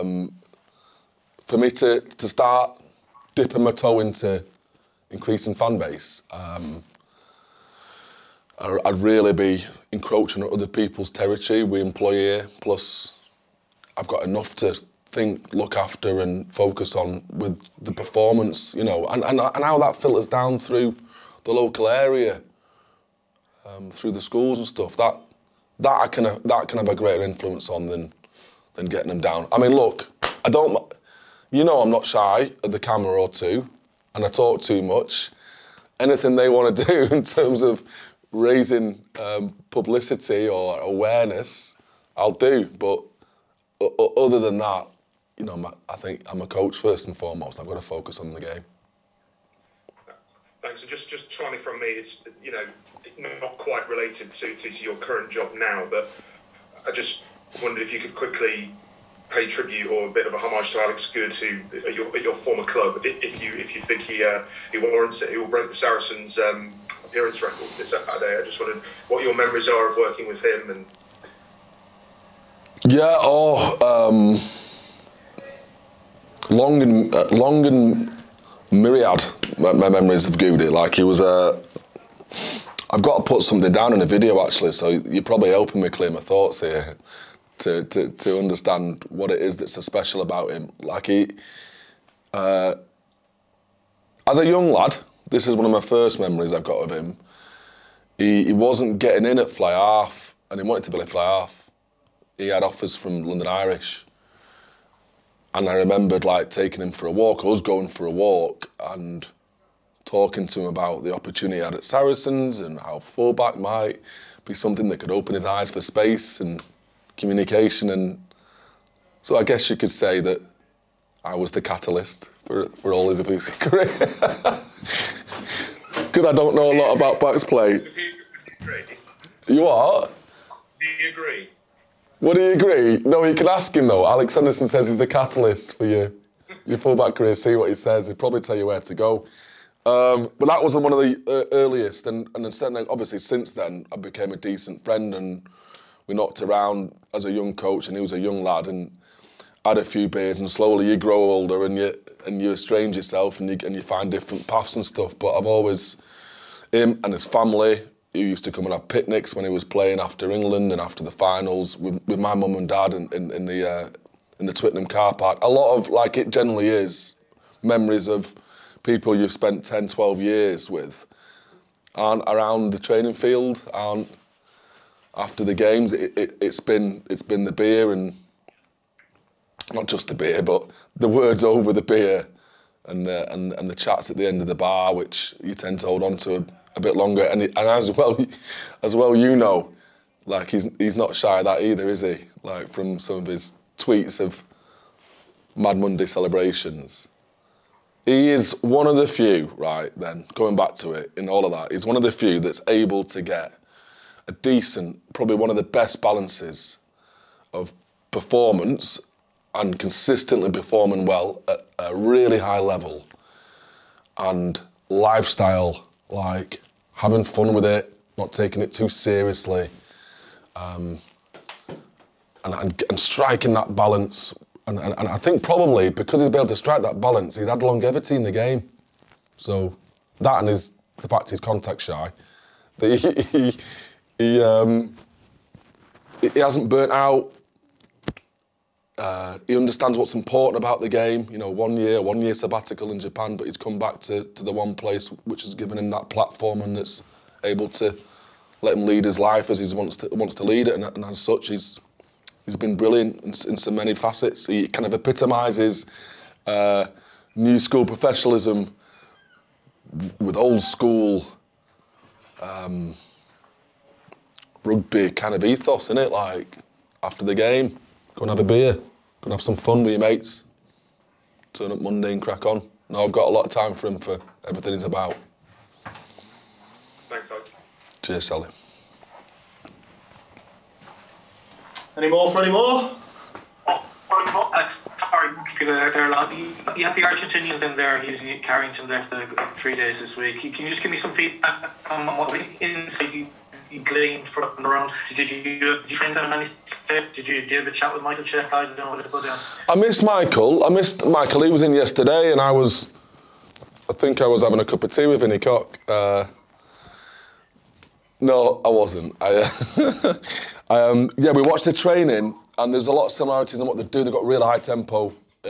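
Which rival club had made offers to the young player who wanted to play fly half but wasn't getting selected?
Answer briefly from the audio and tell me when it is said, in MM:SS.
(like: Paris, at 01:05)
London Irish, at 01:43.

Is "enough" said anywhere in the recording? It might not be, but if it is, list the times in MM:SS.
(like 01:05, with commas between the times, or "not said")
00:14.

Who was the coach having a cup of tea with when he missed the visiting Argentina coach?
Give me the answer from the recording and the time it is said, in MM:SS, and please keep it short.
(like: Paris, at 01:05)
Vinnie Cock, at 05:05.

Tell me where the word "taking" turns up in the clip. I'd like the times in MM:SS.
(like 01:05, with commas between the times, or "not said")
01:46, 03:38.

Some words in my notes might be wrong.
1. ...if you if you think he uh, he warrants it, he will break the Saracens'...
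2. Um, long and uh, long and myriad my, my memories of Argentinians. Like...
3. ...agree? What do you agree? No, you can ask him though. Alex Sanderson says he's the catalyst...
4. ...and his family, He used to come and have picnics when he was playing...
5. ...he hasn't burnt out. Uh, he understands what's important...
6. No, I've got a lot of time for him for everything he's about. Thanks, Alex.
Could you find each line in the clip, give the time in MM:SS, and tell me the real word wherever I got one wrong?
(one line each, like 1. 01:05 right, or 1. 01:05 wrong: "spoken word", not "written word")
1. 01:03 right
2. 01:13 wrong: "Goody", not "Argentinians"
3. 02:11 right
4. 02:37 right
5. 03:56 right
6. 04:32 right.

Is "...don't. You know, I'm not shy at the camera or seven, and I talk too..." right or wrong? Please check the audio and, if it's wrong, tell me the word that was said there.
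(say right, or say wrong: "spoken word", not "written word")
wrong: "two", not "seven".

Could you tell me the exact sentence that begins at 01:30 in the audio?
Like he, uh, as a young lad, this is one of my first memories I've got of him.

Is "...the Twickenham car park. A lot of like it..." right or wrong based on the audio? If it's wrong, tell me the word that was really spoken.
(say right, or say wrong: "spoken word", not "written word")
right.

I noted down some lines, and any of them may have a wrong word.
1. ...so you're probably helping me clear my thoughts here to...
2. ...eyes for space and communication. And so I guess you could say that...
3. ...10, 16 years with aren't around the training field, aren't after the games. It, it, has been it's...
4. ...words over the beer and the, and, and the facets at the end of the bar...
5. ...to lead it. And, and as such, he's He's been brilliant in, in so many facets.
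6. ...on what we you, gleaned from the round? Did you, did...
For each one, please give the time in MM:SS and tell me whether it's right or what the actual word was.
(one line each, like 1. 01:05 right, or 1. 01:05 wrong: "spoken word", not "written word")
1. 01:24 right
2. 01:55 right
3. 02:49 wrong: "12", not "16"
4. 03:01 wrong: "chats", not "facets"
5. 04:10 right
6. 04:51 right.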